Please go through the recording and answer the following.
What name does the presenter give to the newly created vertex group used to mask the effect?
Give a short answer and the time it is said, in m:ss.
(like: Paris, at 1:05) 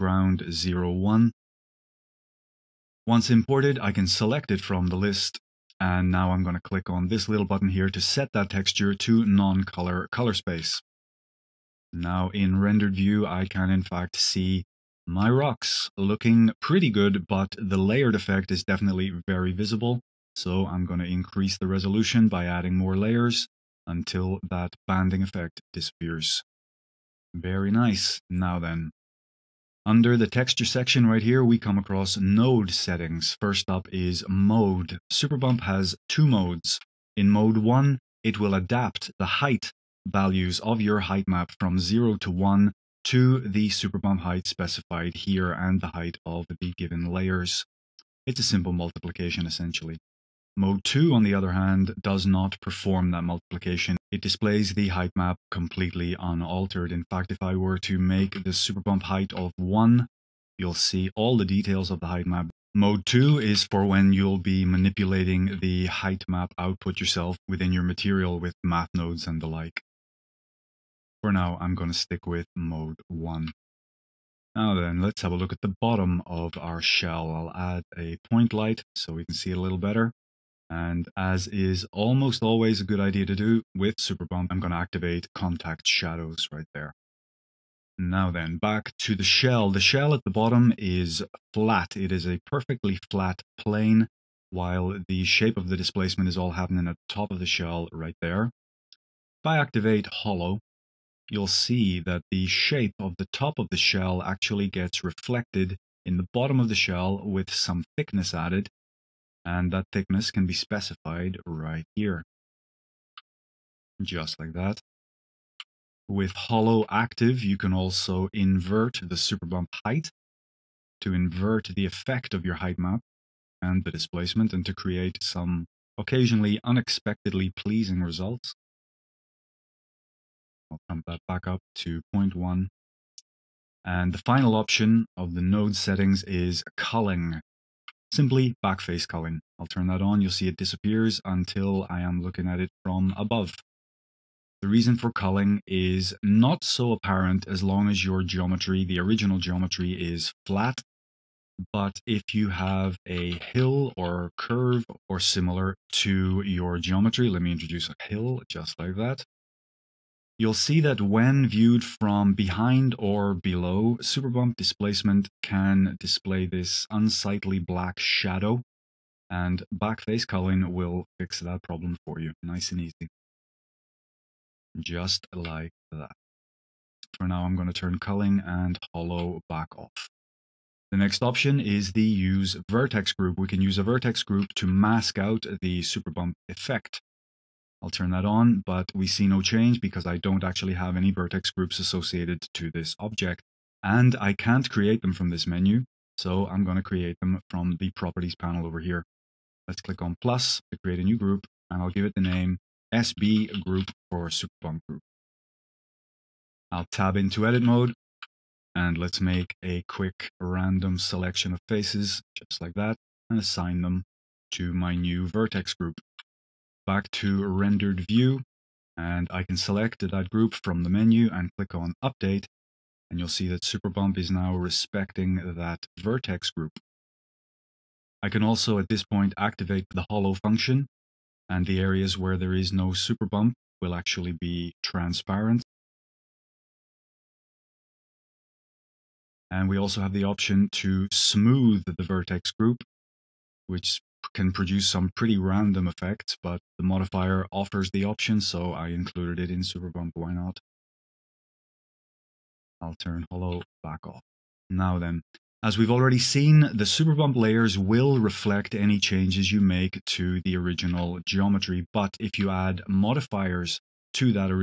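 SB group, at 3:22.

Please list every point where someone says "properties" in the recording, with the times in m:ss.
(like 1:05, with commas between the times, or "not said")
3:17.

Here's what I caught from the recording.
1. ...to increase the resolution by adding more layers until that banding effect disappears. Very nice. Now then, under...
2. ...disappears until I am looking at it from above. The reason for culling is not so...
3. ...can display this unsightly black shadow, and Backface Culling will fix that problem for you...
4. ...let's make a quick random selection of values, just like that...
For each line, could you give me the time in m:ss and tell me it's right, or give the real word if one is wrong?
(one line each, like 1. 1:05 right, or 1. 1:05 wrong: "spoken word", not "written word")
1. 0:20 right
2. 2:20 right
3. 2:45 right
4. 3:28 wrong: "faces", not "values".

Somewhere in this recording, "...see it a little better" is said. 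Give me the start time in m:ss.
1:19.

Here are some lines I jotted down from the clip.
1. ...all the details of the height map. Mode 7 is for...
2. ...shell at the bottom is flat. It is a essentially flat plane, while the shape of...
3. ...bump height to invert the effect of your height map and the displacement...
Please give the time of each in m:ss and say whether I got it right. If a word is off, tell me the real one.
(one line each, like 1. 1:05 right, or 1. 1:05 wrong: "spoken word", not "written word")
1. 1:01 wrong: "2", not "7"
2. 1:29 wrong: "perfectly", not "essentially"
3. 1:59 right.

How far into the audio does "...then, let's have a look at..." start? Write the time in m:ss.
1:14.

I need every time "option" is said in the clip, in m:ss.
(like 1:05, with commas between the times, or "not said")
2:14, 3:01, 4:00, 4:08.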